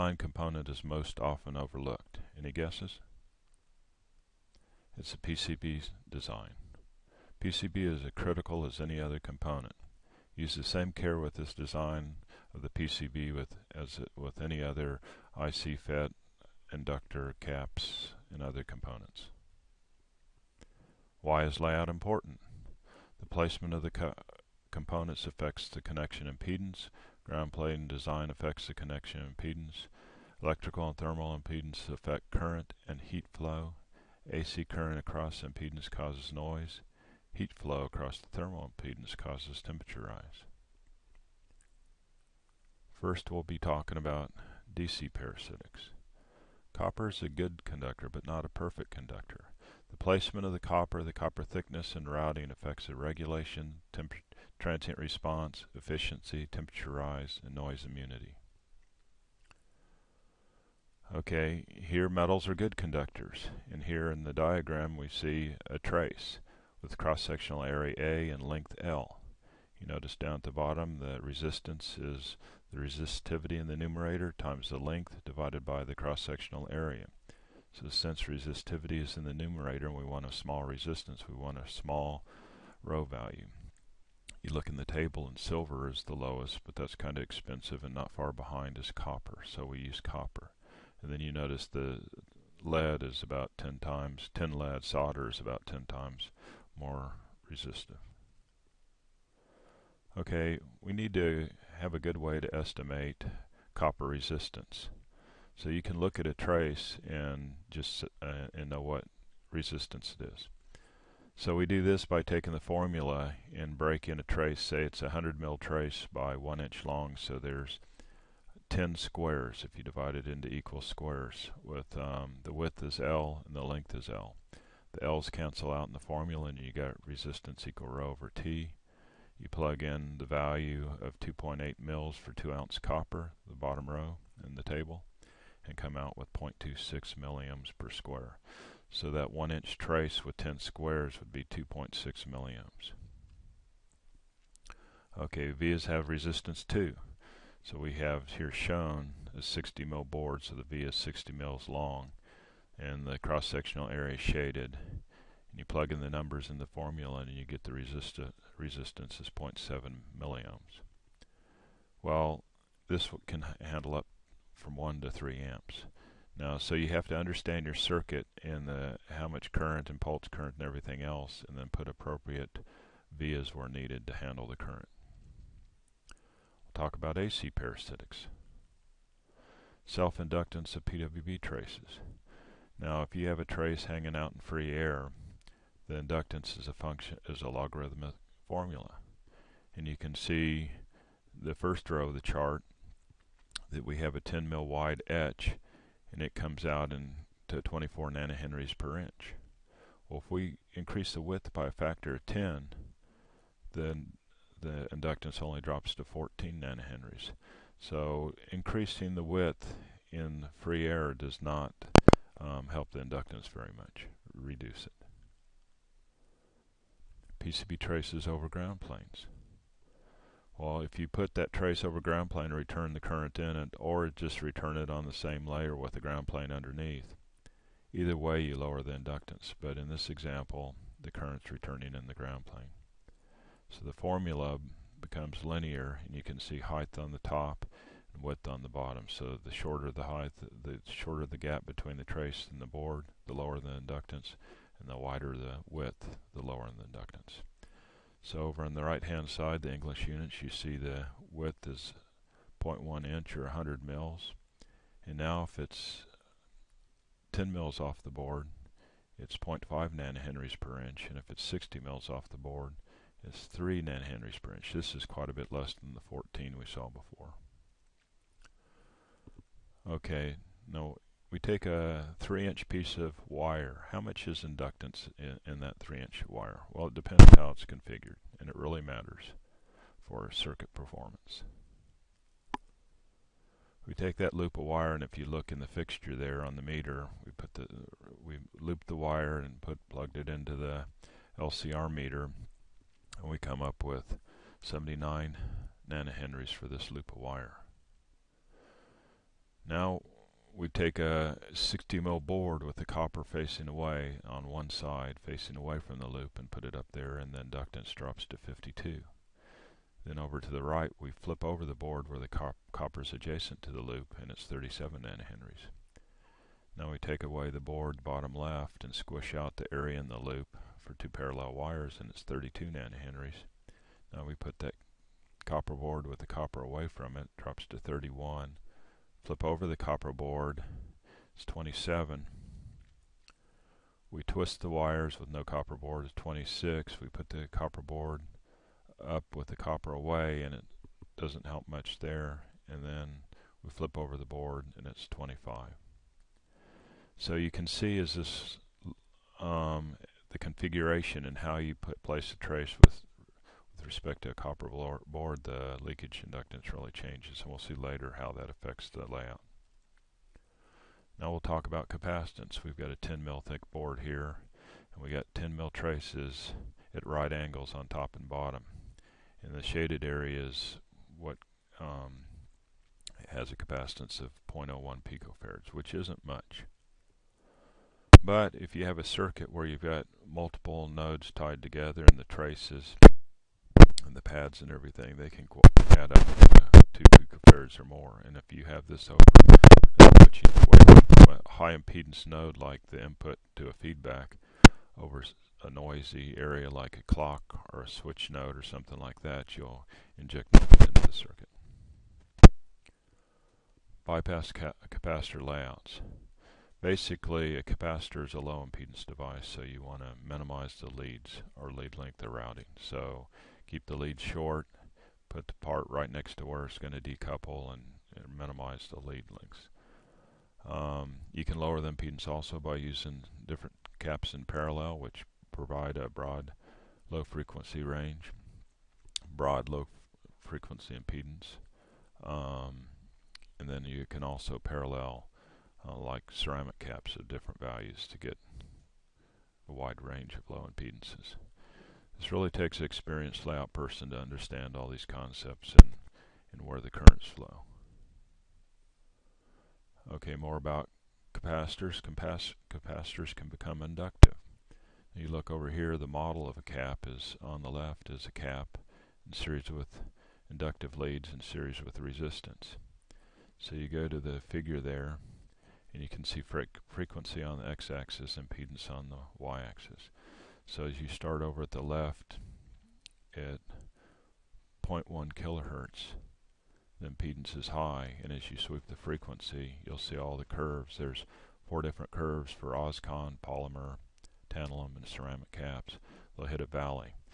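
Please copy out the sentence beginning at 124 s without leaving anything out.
The L's cancel out in the formula and you got resistance equal rho over T.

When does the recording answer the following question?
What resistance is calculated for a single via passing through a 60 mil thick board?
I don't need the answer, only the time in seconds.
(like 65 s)
159 s.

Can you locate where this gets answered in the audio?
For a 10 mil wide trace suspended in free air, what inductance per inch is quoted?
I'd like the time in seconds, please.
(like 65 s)
197 s.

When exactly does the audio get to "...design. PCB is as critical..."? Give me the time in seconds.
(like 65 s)
6 s.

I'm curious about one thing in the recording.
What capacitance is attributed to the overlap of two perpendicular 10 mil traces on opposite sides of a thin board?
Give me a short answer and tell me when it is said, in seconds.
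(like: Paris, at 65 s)
0.01 picofarads, at 374 s.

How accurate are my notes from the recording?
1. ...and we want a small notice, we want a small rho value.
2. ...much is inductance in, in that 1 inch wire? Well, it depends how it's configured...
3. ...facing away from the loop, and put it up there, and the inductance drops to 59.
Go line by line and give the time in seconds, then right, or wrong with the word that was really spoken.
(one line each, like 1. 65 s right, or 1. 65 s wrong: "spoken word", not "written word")
1. 79 s wrong: "resistance", not "notice"
2. 274 s wrong: "3", not "1"
3. 305 s wrong: "52", not "59".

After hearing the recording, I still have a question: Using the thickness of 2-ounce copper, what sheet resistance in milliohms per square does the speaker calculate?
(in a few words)
0.26 milliohms.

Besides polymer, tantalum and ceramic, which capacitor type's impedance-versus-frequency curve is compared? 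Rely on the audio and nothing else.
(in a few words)
OSCON.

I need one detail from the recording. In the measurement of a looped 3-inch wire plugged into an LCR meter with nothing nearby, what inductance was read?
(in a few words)
79 nanohenries.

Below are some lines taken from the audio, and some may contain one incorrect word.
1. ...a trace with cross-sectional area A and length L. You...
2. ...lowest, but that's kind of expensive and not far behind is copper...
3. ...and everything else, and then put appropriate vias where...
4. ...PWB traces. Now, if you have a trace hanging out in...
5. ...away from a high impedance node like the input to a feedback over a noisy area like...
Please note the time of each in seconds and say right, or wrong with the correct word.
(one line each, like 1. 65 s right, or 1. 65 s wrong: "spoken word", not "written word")
1. 65 s right
2. 86 s right
3. 170 s right
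4. 180 s right
5. 390 s right.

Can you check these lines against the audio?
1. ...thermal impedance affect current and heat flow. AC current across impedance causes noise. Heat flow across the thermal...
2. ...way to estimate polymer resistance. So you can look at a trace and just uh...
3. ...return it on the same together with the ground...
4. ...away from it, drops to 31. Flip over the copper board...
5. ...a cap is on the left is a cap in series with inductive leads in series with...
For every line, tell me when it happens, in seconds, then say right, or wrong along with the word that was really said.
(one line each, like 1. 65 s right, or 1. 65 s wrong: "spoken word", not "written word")
1. 30 s right
2. 102 s wrong: "copper", not "polymer"
3. 224 s wrong: "layer", not "together"
4. 326 s right
5. 456 s right.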